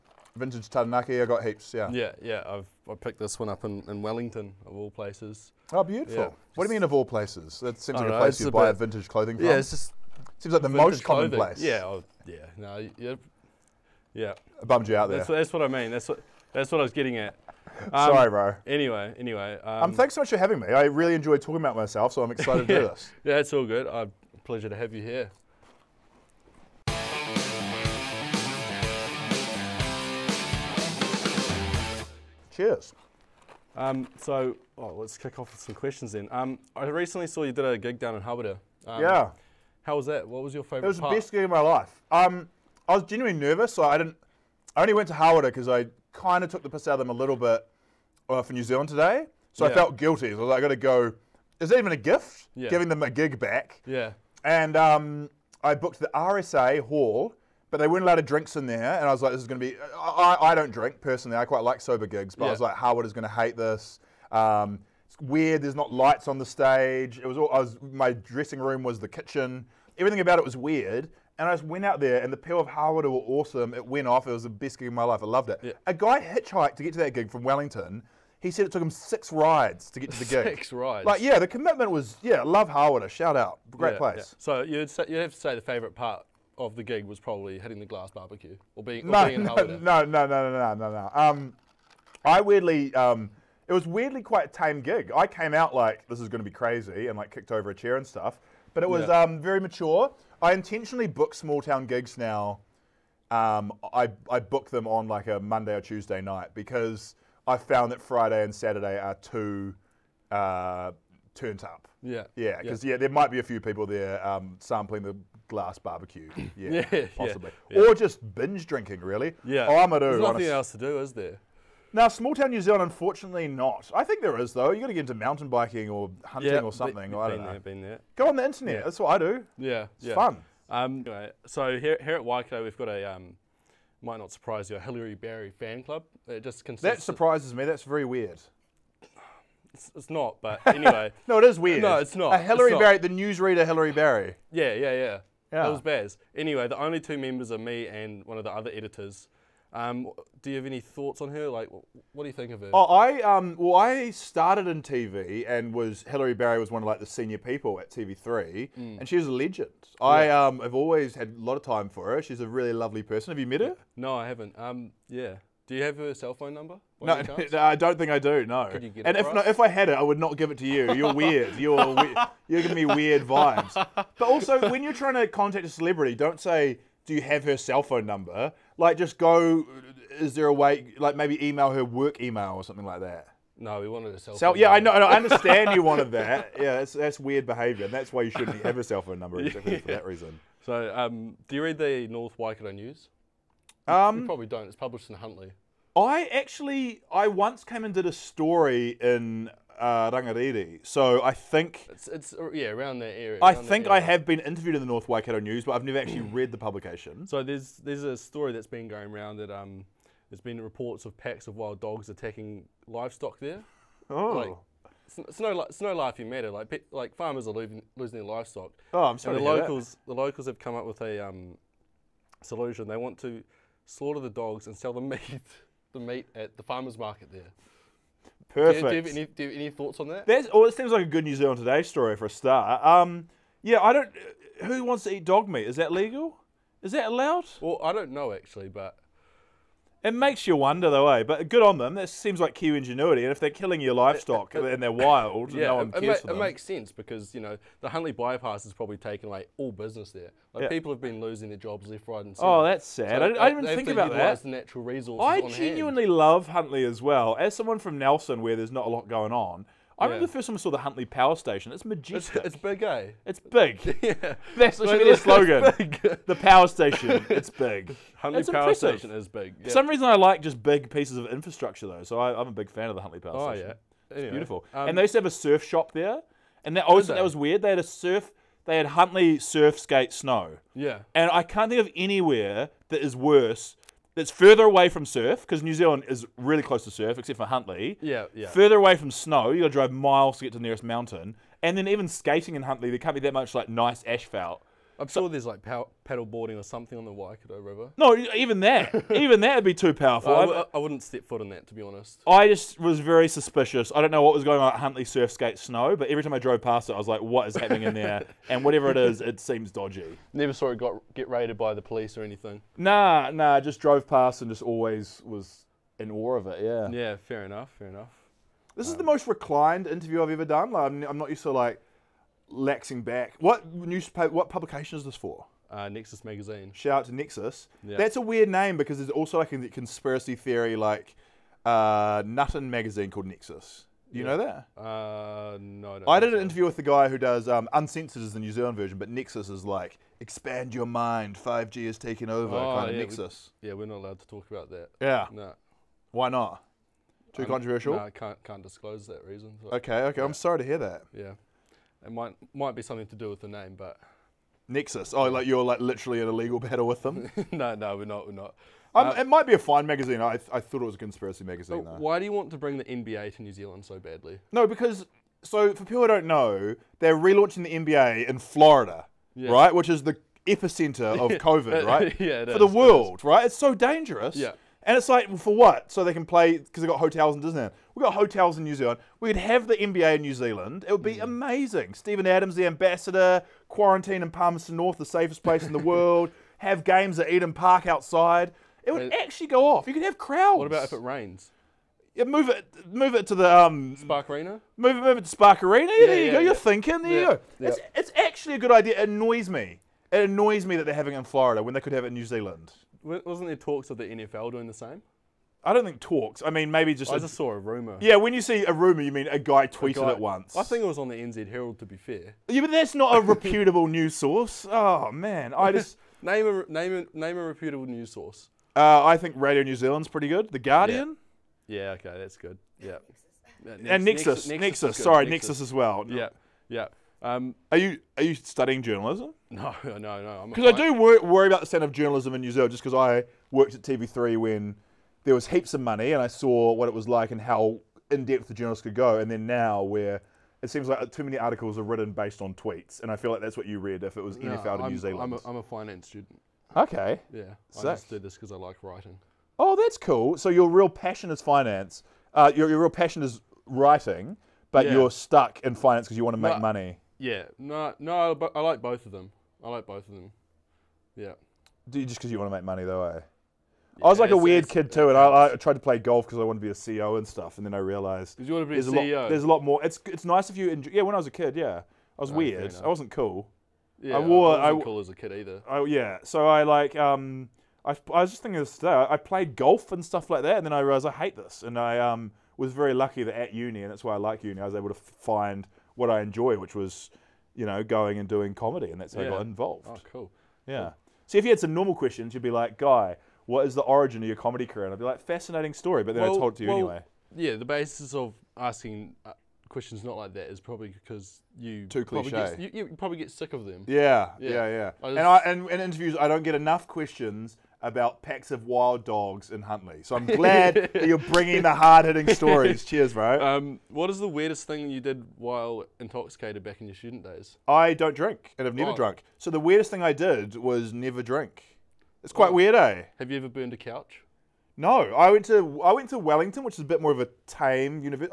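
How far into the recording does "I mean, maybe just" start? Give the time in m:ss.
6:46.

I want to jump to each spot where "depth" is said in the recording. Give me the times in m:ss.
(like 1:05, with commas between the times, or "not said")
7:18.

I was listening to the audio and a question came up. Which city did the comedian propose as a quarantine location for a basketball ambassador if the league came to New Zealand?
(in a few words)
Palmerston North.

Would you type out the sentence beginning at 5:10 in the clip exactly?
Never saw it got get raided by the police or anything.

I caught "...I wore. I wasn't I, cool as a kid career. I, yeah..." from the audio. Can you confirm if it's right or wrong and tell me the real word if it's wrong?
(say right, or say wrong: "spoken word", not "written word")
wrong: "either", not "career".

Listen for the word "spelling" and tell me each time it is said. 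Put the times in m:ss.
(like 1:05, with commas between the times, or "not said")
not said.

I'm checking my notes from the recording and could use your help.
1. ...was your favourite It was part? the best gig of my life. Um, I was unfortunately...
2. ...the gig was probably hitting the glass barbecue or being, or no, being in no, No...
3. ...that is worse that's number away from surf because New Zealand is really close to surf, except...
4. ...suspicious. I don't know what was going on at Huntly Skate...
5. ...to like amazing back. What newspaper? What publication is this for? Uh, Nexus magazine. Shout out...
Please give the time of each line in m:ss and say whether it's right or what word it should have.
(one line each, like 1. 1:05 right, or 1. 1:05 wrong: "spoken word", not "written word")
1. 0:40 wrong: "genuinely", not "unfortunately"
2. 1:26 right
3. 4:42 wrong: "further", not "number"
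4. 5:03 right
5. 5:21 wrong: "laxing", not "amazing".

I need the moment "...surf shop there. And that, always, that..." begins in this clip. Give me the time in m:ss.
4:35.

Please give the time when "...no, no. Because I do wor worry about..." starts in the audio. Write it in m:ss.
7:09.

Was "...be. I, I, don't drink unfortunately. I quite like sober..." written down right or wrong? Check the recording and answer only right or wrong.
wrong.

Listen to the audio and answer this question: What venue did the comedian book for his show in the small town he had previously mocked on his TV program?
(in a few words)
RSA Hall.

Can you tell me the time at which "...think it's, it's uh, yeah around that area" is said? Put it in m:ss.
3:21.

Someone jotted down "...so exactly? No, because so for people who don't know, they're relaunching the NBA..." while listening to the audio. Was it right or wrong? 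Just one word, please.
wrong.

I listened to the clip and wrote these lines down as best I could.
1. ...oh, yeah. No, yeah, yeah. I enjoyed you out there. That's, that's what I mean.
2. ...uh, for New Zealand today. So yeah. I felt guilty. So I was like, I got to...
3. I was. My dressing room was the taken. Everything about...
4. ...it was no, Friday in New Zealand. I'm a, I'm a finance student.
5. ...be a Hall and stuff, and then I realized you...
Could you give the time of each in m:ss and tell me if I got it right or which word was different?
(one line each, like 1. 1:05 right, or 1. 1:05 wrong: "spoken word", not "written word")
1. 0:11 wrong: "bummed", not "enjoyed"
2. 0:48 right
3. 1:07 wrong: "kitchen", not "taken"
4. 7:24 wrong: "NFL", not "Friday"
5. 7:46 wrong: "CEO", not "Hall".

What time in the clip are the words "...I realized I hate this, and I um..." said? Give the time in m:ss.
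8:00.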